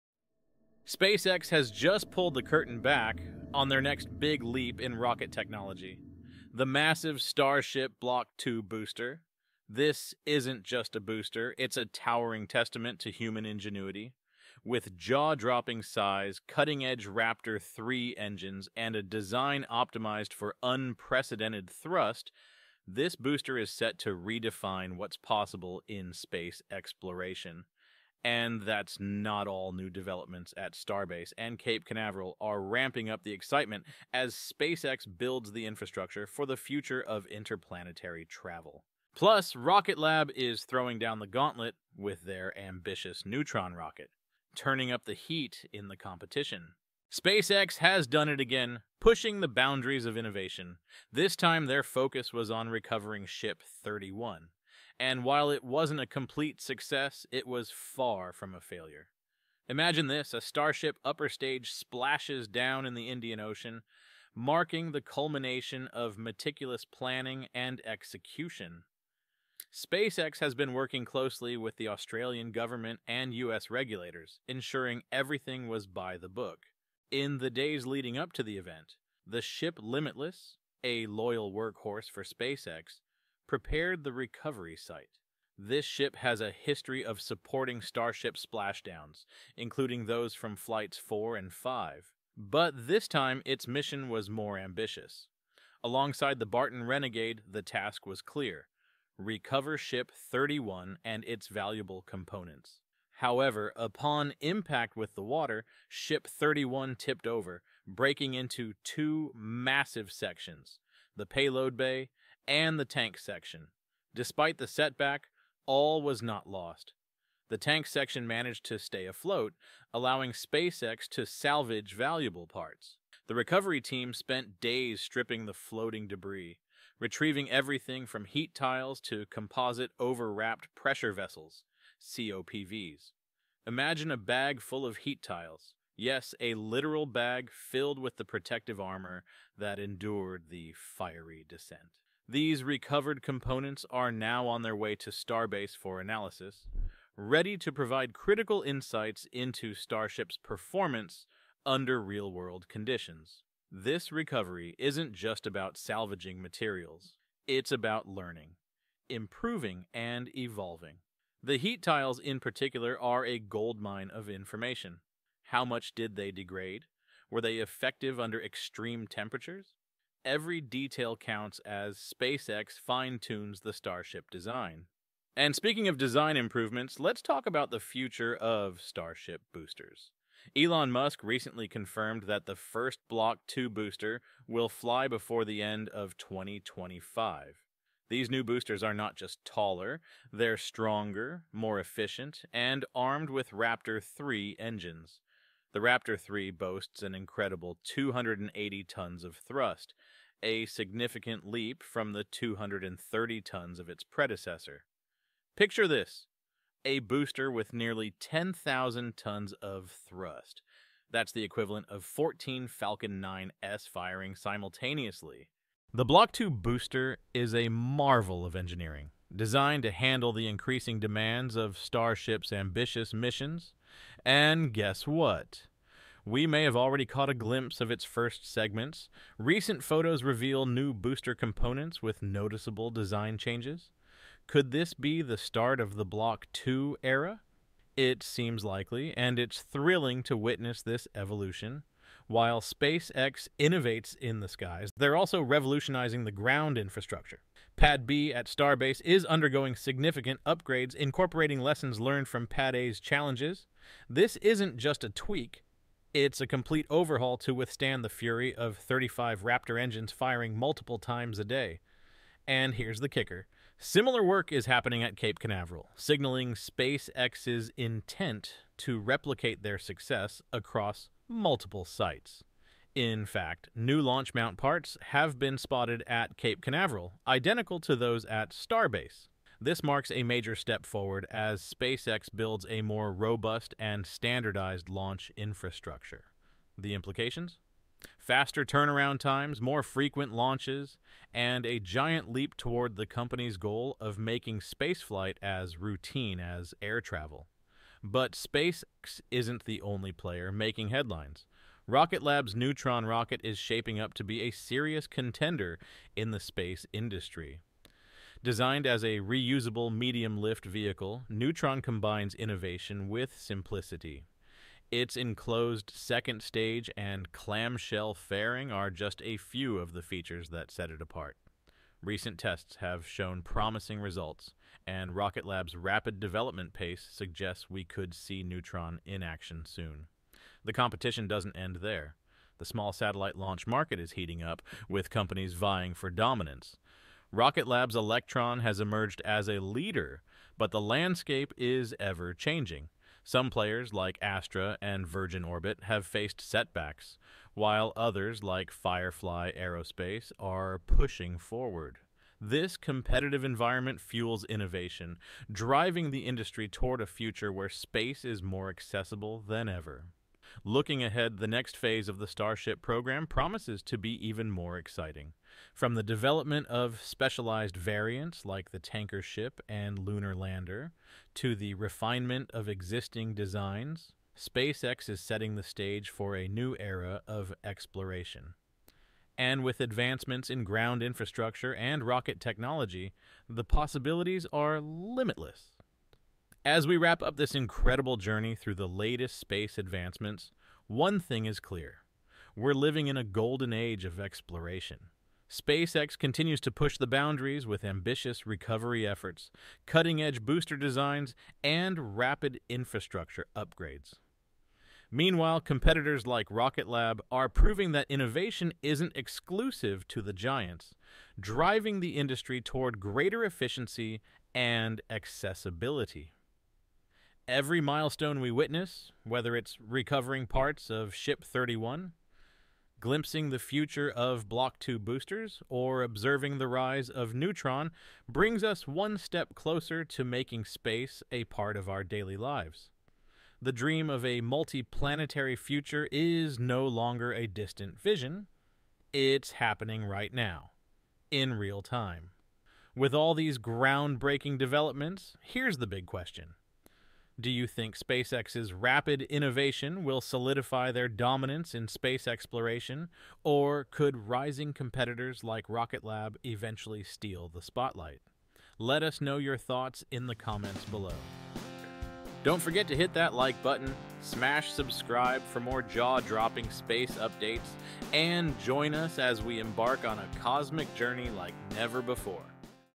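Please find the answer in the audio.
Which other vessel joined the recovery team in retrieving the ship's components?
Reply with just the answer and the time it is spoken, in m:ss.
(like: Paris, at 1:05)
Barton Renegade, at 1:36.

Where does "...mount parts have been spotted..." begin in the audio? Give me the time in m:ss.
4:34.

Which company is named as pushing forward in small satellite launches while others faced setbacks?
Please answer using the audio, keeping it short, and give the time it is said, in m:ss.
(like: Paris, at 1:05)
Firefly Aerospace, at 5:48.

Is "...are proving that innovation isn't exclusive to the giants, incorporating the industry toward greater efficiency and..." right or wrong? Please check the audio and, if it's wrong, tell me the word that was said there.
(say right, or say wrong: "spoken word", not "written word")
wrong: "driving", not "incorporating".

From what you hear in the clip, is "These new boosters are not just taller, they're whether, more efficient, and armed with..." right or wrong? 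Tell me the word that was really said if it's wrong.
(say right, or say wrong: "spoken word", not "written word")
wrong: "stronger", not "whether".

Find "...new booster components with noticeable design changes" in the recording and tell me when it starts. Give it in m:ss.
3:50.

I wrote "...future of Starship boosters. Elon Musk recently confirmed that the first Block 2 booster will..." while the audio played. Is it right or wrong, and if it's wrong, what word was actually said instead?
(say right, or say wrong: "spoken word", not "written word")
right.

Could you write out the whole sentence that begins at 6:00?
Looking ahead, the next phase of the Starship program promises to be even more exciting.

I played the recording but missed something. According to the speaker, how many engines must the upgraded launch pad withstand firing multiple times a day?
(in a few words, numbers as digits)
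35.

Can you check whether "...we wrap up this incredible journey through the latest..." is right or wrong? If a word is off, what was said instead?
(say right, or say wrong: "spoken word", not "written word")
right.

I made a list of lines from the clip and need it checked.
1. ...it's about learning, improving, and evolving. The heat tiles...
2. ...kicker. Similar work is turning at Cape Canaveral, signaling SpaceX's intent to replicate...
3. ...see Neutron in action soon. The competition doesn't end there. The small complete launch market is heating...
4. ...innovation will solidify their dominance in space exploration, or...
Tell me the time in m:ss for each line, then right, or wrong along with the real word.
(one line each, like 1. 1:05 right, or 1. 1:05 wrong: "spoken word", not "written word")
1. 2:37 right
2. 4:23 wrong: "happening", not "turning"
3. 5:28 wrong: "satellite", not "complete"
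4. 7:29 right.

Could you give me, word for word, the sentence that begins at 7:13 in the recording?
The dream of a multi-planetary future is no longer a distant vision.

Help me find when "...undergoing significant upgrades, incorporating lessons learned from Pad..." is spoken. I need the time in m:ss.
4:09.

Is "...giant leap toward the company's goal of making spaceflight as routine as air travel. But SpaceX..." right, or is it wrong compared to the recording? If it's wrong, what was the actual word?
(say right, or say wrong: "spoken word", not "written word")
right.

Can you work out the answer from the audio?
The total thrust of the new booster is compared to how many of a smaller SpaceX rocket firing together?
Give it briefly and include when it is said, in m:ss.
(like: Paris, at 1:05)
14, at 3:32.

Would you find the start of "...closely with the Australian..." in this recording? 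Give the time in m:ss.
1:11.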